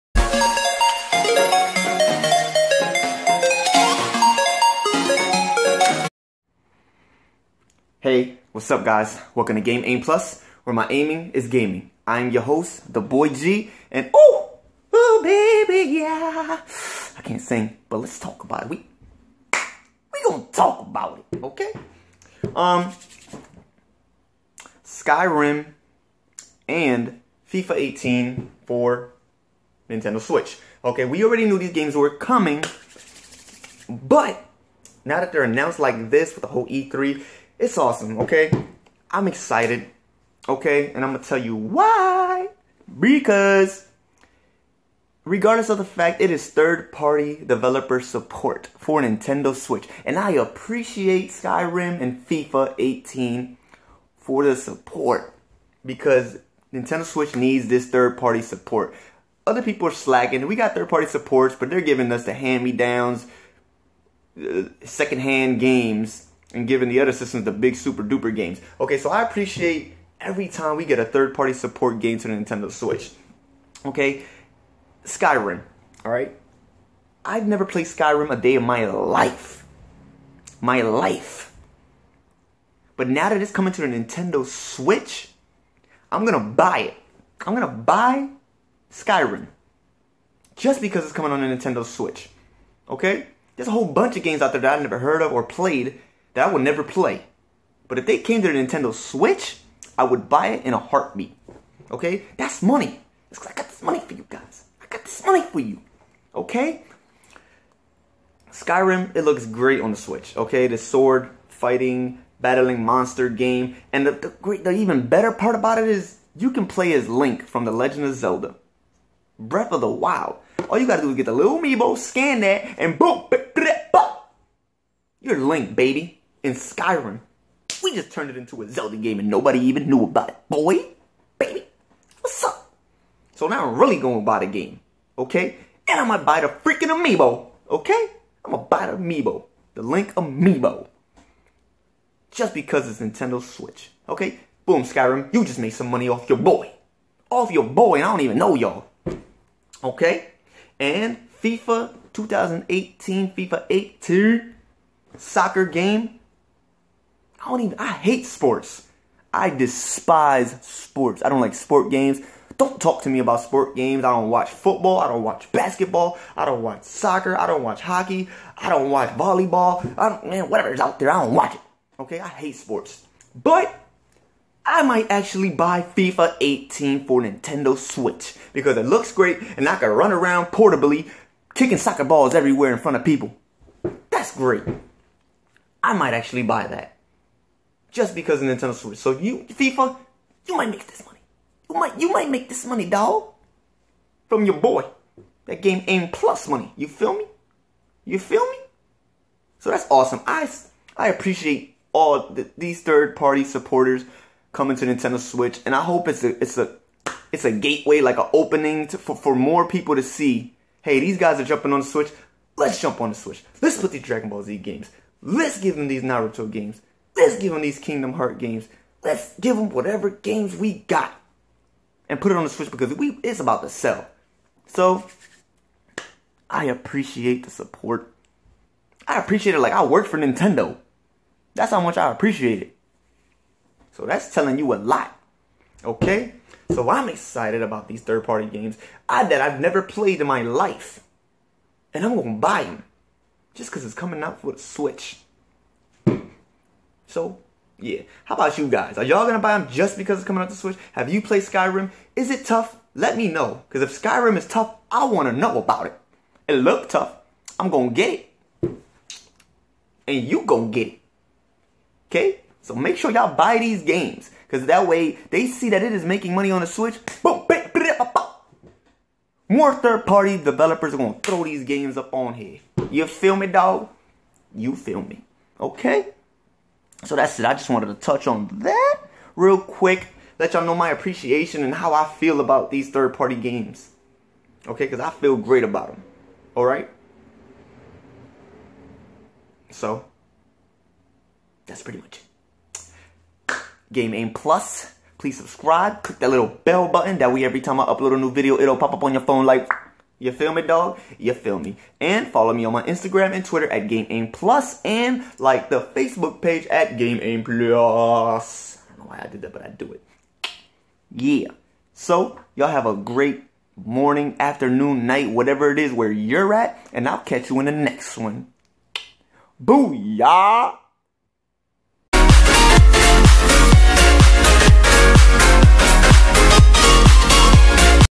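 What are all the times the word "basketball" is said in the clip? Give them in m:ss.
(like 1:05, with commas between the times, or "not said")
2:45.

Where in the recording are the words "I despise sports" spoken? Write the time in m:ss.
2:39.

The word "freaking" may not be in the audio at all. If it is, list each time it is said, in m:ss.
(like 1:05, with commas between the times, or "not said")
2:16.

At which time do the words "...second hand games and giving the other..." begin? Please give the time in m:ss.
1:04.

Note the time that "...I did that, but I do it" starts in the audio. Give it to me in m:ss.
5:09.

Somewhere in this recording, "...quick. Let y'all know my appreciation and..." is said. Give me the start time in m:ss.
4:39.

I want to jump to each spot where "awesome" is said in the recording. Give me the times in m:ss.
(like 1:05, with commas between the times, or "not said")
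0:37, 3:19.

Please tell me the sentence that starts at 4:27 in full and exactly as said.
Boom, bam, more third party developers are gonna throw these games up on here.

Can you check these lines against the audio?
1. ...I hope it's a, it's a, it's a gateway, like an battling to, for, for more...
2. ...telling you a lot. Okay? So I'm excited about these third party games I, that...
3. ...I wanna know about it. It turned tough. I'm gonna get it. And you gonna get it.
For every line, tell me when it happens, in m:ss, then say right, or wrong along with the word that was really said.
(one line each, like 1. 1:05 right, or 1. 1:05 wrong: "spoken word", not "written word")
1. 3:25 wrong: "opening", not "battling"
2. 3:54 right
3. 4:14 wrong: "looked", not "turned".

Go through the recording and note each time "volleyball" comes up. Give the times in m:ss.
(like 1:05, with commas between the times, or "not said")
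2:49.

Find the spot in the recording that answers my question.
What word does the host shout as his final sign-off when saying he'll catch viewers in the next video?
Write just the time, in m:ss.
5:19.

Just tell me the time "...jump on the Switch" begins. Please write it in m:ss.
3:32.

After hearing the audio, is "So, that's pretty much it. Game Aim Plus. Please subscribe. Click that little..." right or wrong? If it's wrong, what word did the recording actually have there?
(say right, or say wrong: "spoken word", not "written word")
right.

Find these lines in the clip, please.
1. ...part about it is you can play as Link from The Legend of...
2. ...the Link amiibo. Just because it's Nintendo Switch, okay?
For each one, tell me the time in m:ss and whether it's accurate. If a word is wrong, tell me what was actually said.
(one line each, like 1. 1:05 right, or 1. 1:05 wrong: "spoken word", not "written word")
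1. 1:55 right
2. 2:19 right.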